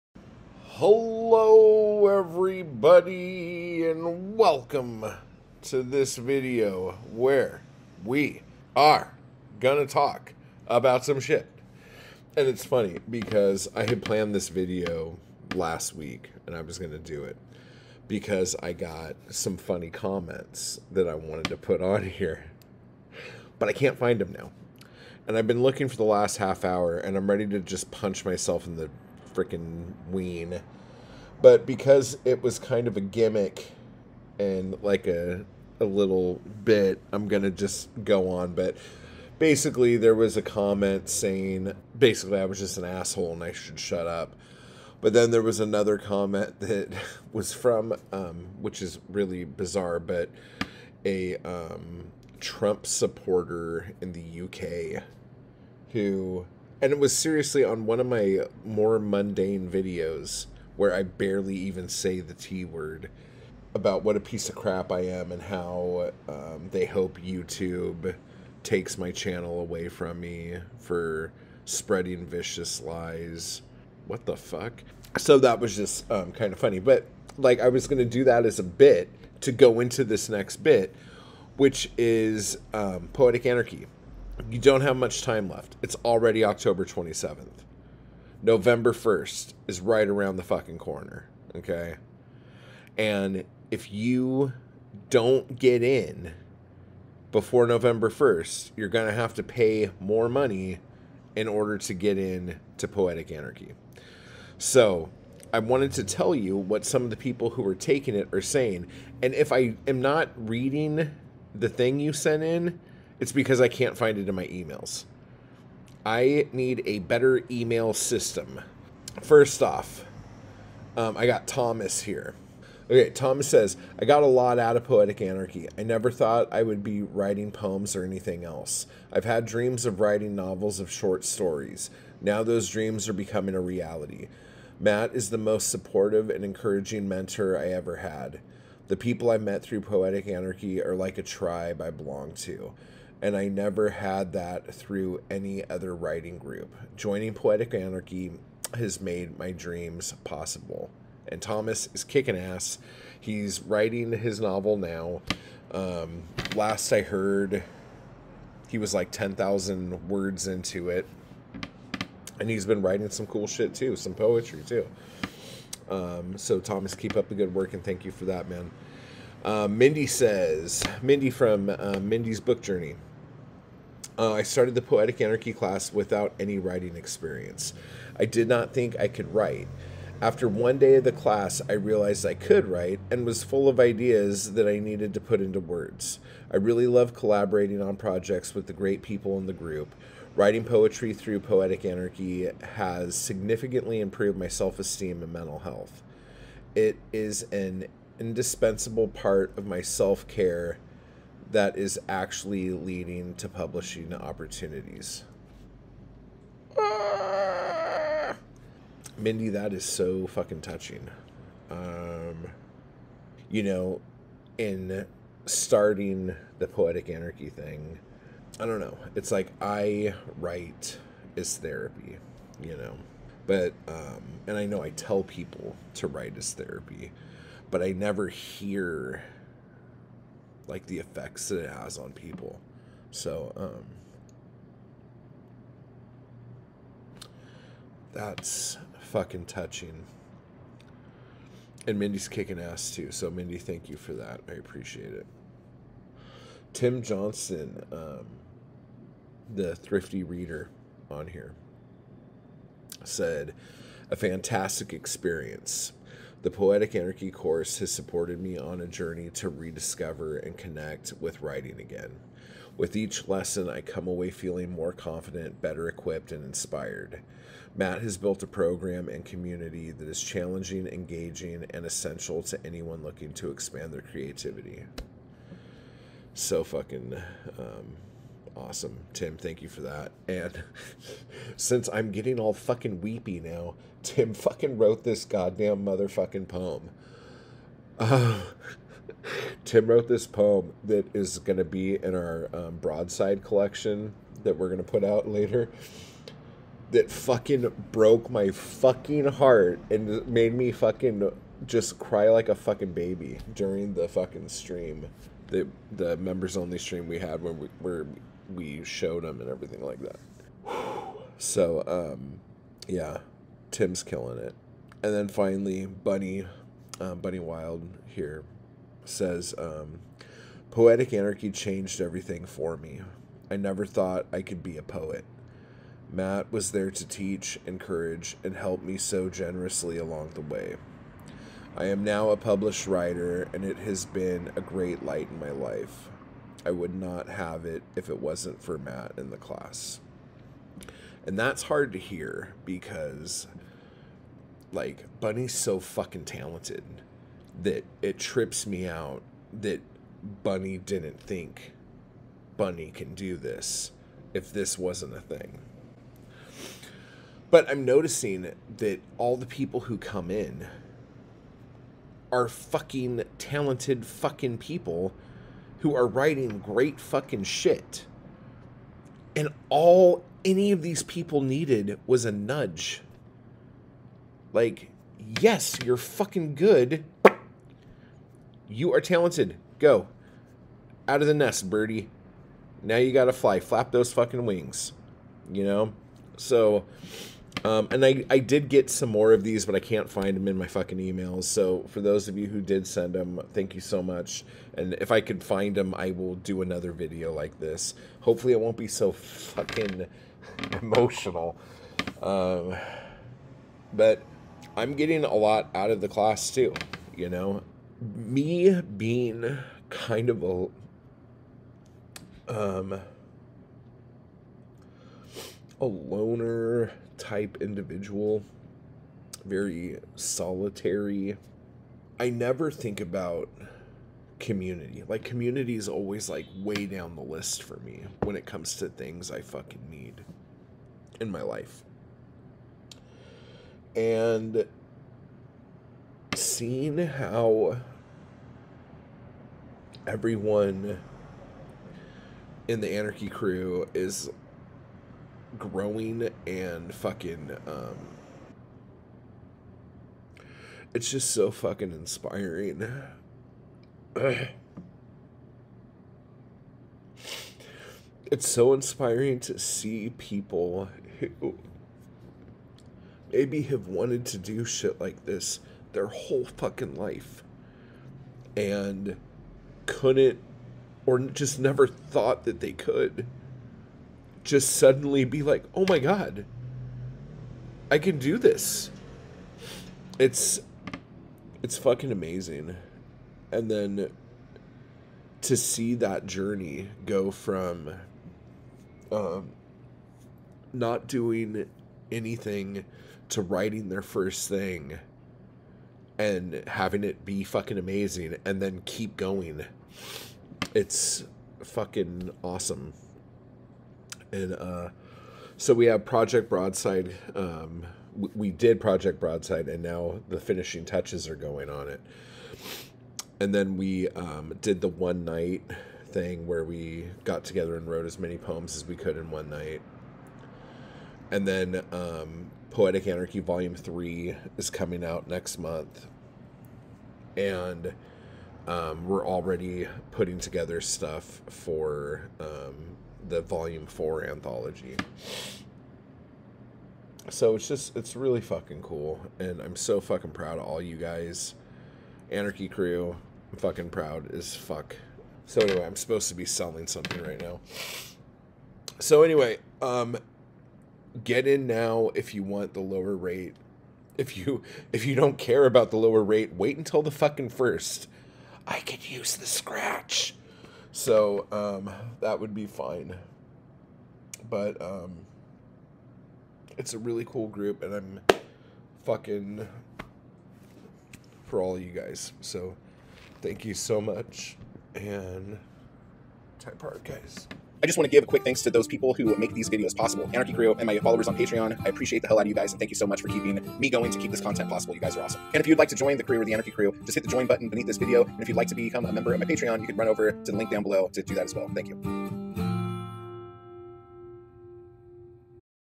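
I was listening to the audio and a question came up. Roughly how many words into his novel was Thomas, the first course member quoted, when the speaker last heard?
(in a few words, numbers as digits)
10,000.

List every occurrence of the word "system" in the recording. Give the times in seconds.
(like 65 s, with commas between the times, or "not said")
117 s.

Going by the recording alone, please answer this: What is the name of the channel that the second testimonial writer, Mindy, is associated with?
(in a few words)
Mindy's Book Journey.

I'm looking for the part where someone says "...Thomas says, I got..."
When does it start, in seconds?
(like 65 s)
123 s.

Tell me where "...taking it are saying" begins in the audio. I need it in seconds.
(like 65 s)
107 s.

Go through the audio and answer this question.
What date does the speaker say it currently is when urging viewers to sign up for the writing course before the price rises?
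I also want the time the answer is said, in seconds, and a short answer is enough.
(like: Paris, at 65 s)
October 27th, at 86 s.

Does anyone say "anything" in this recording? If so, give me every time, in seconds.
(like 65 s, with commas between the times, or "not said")
128 s, 492 s.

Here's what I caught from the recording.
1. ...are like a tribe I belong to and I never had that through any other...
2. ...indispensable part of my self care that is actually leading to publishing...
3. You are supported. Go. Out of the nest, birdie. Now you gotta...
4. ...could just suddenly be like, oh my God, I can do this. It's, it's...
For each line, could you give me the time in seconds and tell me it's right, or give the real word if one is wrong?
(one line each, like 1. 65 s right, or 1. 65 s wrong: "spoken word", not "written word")
1. 140 s right
2. 198 s right
3. 378 s wrong: "talented", not "supported"
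4. 472 s right.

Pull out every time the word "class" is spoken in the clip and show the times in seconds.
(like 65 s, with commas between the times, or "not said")
175 s, 181 s, 339 s, 406 s.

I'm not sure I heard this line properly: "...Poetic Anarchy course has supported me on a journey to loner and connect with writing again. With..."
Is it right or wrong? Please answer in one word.
wrong.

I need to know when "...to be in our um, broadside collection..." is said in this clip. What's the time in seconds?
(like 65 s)
291 s.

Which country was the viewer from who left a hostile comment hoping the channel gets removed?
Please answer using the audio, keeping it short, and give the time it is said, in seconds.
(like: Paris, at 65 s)
UK, at 54 s.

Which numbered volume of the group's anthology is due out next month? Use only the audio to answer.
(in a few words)
Volume 3.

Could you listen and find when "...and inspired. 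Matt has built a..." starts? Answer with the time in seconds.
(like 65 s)
266 s.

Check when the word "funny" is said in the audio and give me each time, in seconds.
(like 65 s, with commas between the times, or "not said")
12 s, 19 s, 76 s.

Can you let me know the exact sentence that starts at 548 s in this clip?
So anyway, um get in now if you want the lower rate.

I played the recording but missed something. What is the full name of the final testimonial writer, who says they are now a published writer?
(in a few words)
Bunny Wild.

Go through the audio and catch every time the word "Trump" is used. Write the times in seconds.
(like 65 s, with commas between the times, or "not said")
52 s.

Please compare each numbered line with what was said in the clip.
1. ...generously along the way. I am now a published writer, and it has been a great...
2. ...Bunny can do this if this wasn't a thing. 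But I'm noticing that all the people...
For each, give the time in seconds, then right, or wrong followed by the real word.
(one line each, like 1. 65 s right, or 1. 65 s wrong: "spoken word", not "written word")
1. 329 s right
2. 352 s right.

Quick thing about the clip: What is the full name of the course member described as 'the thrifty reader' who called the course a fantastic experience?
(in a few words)
Tim Johnson.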